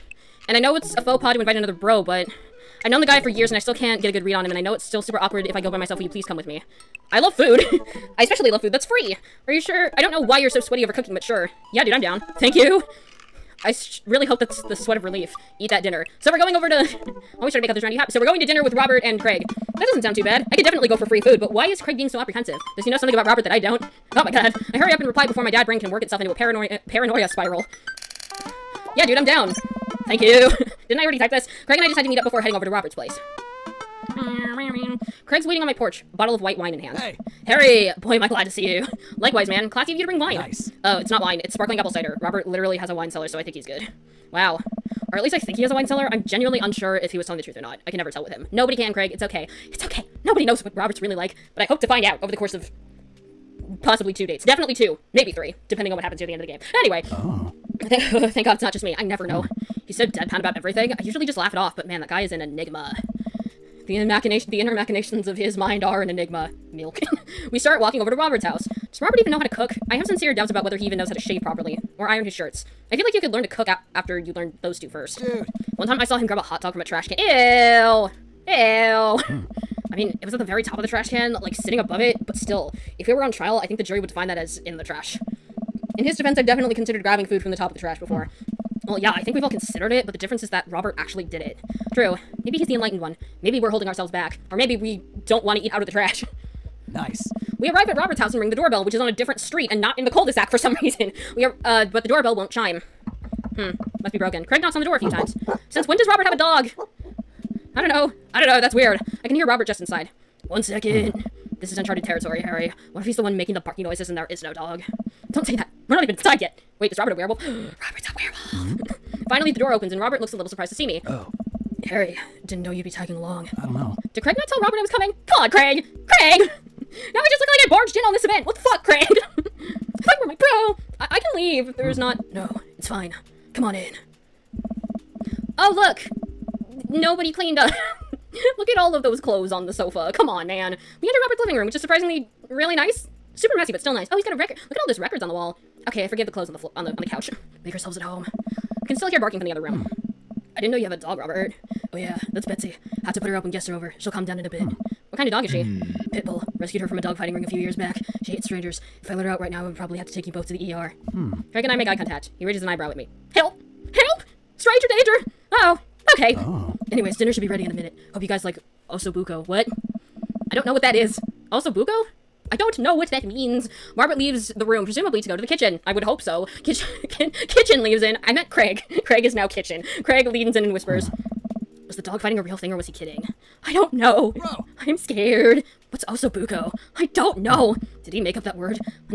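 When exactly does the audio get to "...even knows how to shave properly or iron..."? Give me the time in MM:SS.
01:10.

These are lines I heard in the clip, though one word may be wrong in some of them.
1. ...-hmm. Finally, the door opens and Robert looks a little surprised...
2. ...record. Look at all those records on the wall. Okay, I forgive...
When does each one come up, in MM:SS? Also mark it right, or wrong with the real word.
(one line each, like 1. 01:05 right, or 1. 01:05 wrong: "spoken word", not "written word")
1. 01:58 right
2. 02:24 right.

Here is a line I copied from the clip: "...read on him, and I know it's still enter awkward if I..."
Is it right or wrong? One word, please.
wrong.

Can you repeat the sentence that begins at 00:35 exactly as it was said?
Craig's waiting on my porch, bottle of white wine in hand.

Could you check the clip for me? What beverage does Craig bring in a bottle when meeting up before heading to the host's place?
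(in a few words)
Sparkling apple cider.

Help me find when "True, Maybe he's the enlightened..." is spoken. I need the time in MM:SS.
01:31.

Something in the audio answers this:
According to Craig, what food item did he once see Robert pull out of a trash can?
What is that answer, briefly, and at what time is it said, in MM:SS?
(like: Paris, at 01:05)
Hot dog, at 01:16.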